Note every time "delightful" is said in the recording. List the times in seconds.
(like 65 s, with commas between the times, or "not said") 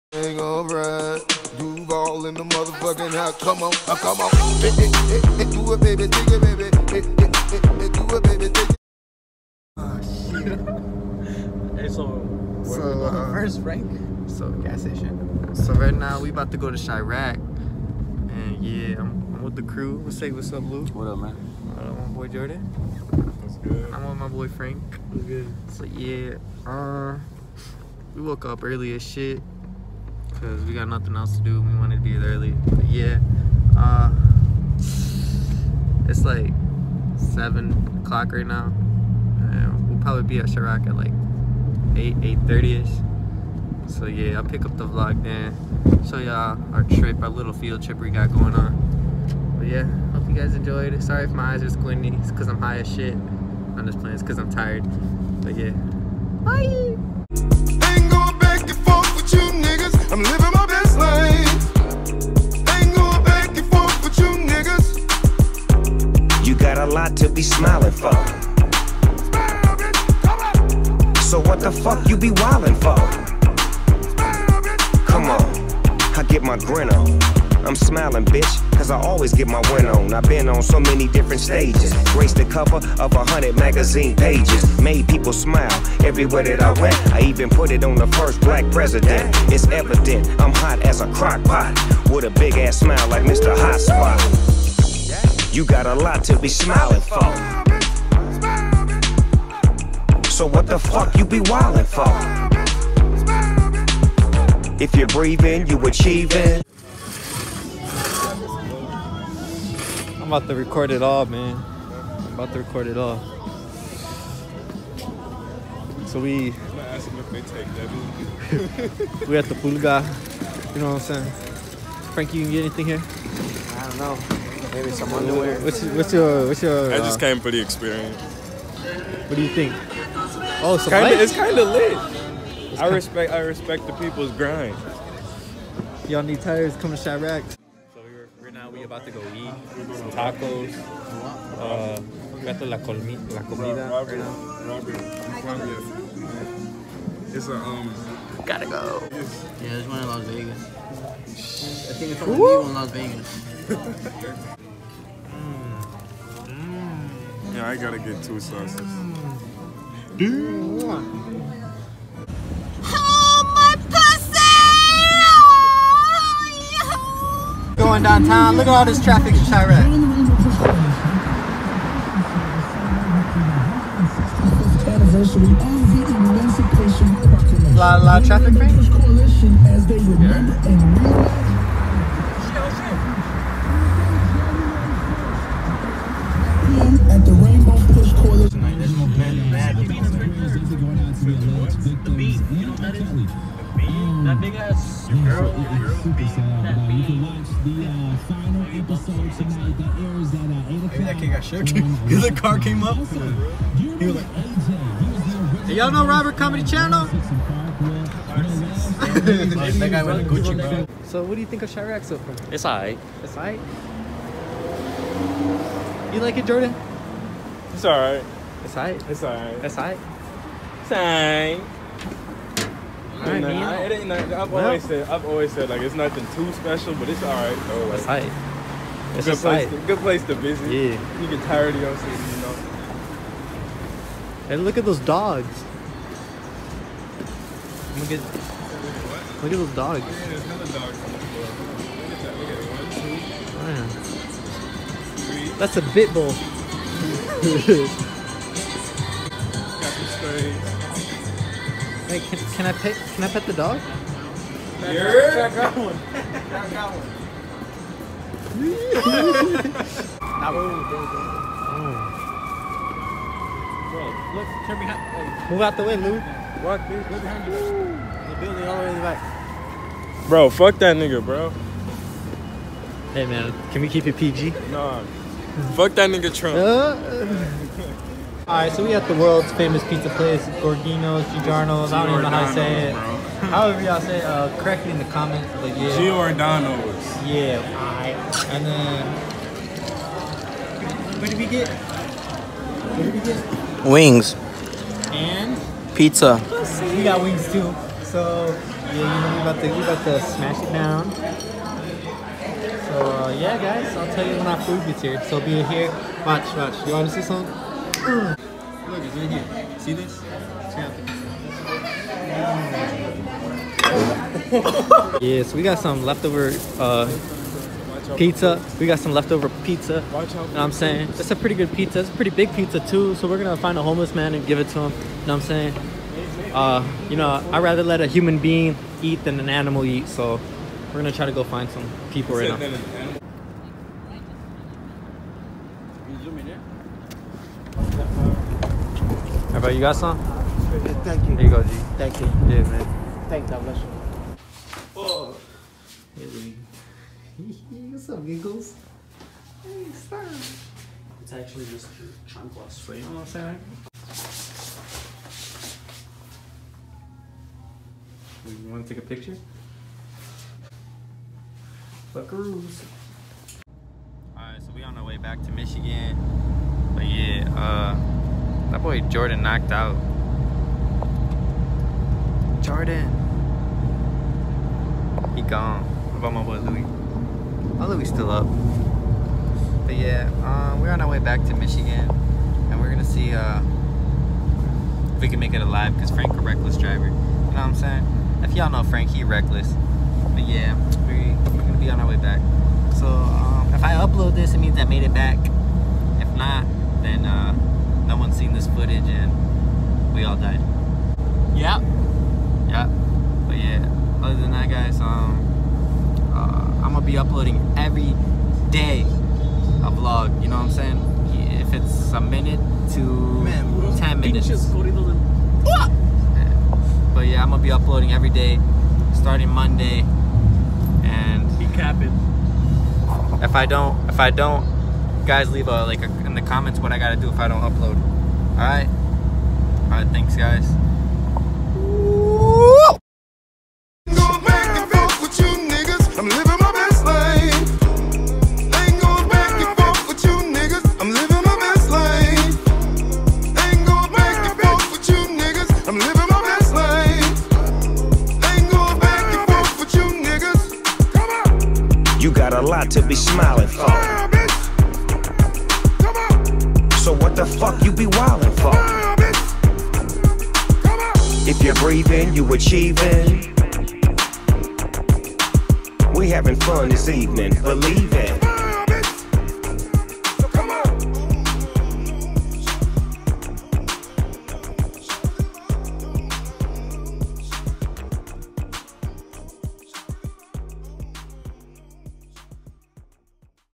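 not said.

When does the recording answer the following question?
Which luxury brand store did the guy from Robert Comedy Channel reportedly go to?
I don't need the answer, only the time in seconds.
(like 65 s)
210 s.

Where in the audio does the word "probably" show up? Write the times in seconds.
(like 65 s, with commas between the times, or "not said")
40 s.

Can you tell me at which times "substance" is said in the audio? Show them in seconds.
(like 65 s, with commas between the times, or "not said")
not said.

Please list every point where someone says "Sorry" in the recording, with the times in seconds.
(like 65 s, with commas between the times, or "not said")
51 s.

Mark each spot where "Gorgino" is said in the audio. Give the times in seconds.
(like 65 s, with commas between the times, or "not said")
280 s.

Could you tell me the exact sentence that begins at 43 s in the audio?
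So yeah, I'll pick up the vlog then.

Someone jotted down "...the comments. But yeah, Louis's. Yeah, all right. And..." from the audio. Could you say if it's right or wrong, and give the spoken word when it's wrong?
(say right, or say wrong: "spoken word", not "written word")
wrong: "Giordano", not "Louis".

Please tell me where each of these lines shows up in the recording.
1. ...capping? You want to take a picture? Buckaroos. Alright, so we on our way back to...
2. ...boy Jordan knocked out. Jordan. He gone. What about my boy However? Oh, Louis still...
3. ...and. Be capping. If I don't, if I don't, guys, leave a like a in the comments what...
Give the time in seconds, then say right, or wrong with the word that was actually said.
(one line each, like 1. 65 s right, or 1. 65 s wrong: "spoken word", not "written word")
1. 353 s wrong: "saying", not "capping"
2. 368 s wrong: "Louis", not "However"
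3. 421 s right.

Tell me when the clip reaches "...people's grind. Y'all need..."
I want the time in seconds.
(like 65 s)
133 s.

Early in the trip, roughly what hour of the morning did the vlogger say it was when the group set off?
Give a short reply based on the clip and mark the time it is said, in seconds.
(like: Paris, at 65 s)
7 o'clock, at 37 s.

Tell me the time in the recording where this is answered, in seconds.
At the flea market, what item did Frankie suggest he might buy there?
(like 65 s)
125 s.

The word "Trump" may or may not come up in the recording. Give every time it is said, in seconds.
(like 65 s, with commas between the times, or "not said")
276 s.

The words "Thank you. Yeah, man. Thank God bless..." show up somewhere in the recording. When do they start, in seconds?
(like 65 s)
341 s.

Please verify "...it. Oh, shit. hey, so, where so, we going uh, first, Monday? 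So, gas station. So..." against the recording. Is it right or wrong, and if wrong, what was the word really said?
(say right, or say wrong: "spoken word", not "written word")
wrong: "Frank", not "Monday".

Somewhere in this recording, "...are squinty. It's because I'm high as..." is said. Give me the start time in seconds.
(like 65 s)
51 s.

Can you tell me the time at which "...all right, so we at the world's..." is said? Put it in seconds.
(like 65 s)
278 s.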